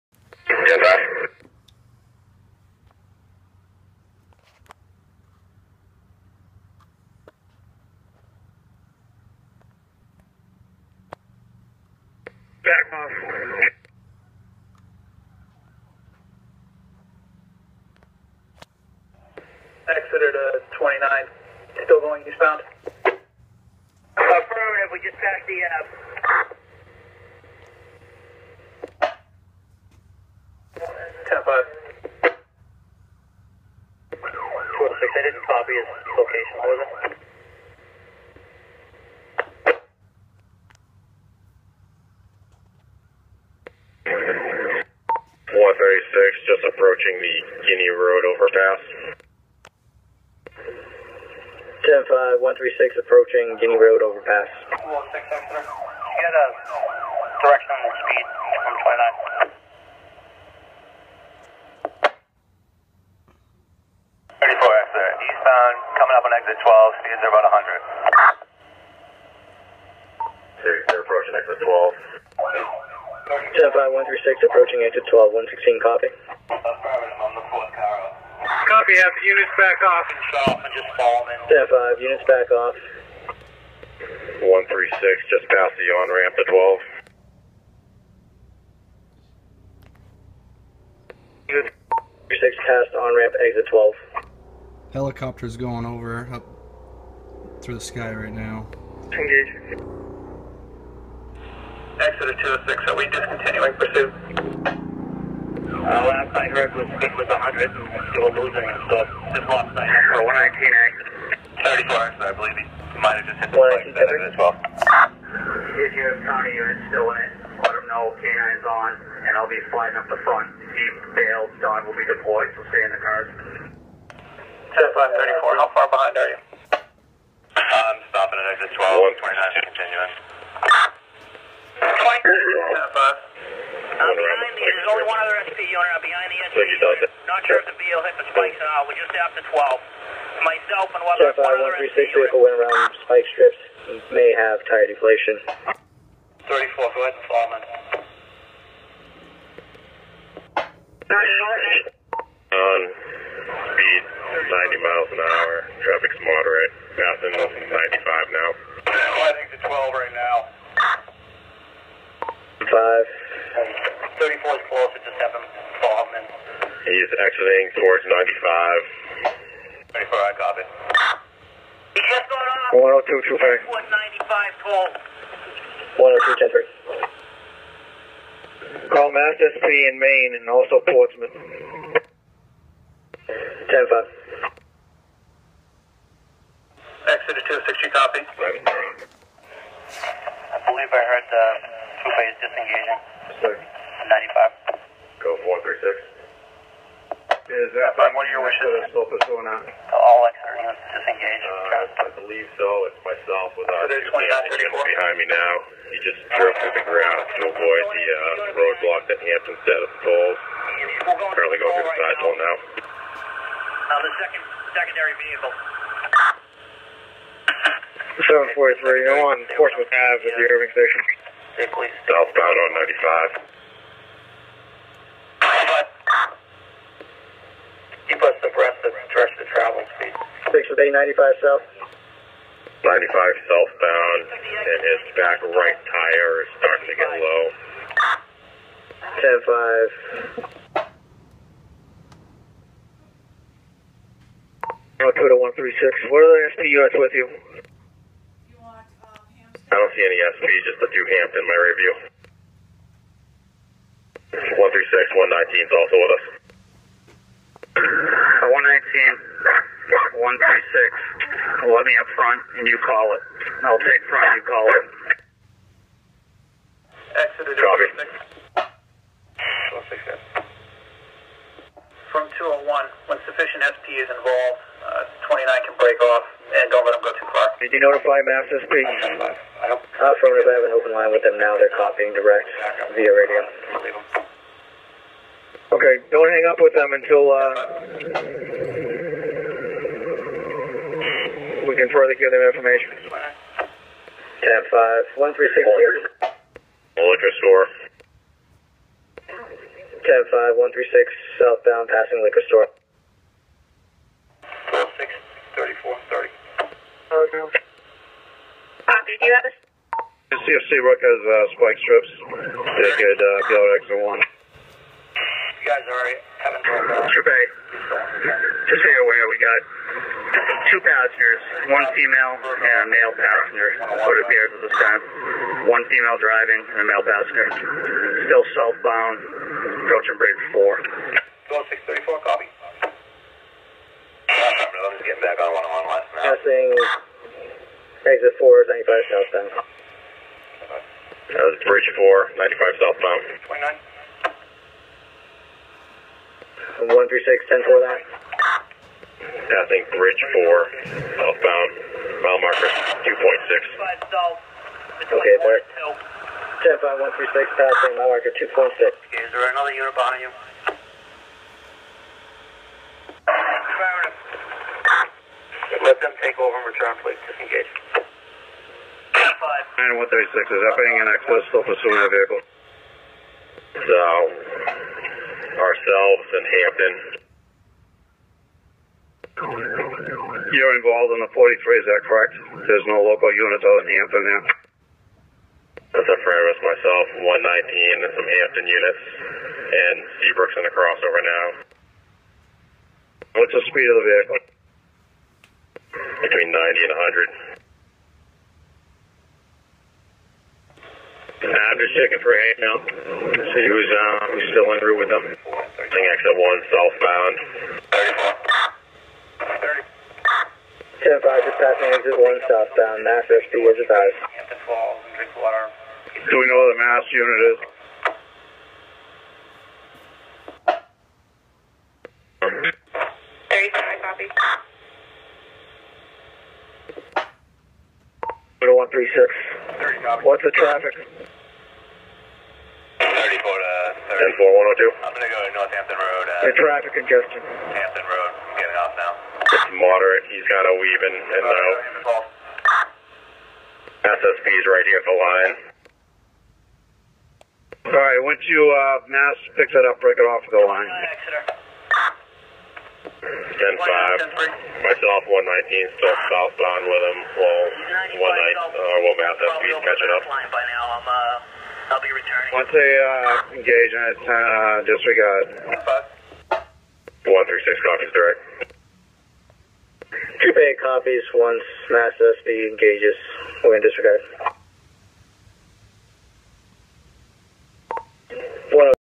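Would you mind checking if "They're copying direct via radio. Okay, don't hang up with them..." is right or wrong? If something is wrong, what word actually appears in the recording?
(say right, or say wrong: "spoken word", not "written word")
right.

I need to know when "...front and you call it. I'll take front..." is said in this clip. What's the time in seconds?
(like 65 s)
262 s.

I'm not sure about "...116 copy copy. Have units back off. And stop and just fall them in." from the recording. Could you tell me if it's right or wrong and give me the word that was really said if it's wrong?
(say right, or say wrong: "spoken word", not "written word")
right.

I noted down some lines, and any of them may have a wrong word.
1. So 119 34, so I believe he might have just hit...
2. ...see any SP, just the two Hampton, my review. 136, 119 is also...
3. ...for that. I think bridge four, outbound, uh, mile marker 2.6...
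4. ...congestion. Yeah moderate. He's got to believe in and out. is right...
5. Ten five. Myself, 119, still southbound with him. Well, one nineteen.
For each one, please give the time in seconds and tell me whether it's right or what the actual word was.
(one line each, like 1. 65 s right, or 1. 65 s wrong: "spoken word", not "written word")
1. 110 s right
2. 249 s right
3. 347 s right
4. 436 s wrong: "weave", not "believe"
5. 453 s right.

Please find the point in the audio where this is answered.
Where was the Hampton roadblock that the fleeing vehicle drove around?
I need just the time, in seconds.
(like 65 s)
209 s.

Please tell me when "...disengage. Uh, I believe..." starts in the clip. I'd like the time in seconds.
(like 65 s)
200 s.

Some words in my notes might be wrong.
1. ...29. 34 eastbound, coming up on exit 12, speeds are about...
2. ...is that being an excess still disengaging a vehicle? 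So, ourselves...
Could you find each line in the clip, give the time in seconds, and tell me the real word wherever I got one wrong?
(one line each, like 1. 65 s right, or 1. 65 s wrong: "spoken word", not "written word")
1. 62 s right
2. 370 s wrong: "pursuing", not "disengaging".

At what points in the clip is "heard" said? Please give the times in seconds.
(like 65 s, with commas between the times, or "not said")
106 s, 191 s.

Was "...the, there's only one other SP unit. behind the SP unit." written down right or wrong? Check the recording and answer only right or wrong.
right.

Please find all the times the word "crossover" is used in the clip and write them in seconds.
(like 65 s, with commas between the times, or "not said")
390 s.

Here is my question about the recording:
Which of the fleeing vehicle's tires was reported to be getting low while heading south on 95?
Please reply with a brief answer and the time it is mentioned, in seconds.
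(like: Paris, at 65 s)
Back right tire, at 235 s.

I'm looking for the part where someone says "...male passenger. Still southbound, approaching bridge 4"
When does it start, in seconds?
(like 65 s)
326 s.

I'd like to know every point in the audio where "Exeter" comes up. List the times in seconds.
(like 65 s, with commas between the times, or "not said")
19 s, 55 s, 267 s.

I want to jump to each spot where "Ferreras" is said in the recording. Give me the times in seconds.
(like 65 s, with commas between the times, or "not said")
386 s.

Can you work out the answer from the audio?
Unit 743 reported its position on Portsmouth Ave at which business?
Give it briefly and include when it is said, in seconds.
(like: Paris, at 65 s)
Irving Station, at 220 s.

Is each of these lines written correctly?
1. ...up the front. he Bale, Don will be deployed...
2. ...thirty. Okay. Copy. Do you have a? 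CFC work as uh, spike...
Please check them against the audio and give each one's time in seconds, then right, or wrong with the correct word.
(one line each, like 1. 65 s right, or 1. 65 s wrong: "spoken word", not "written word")
1. 119 s right
2. 306 s right.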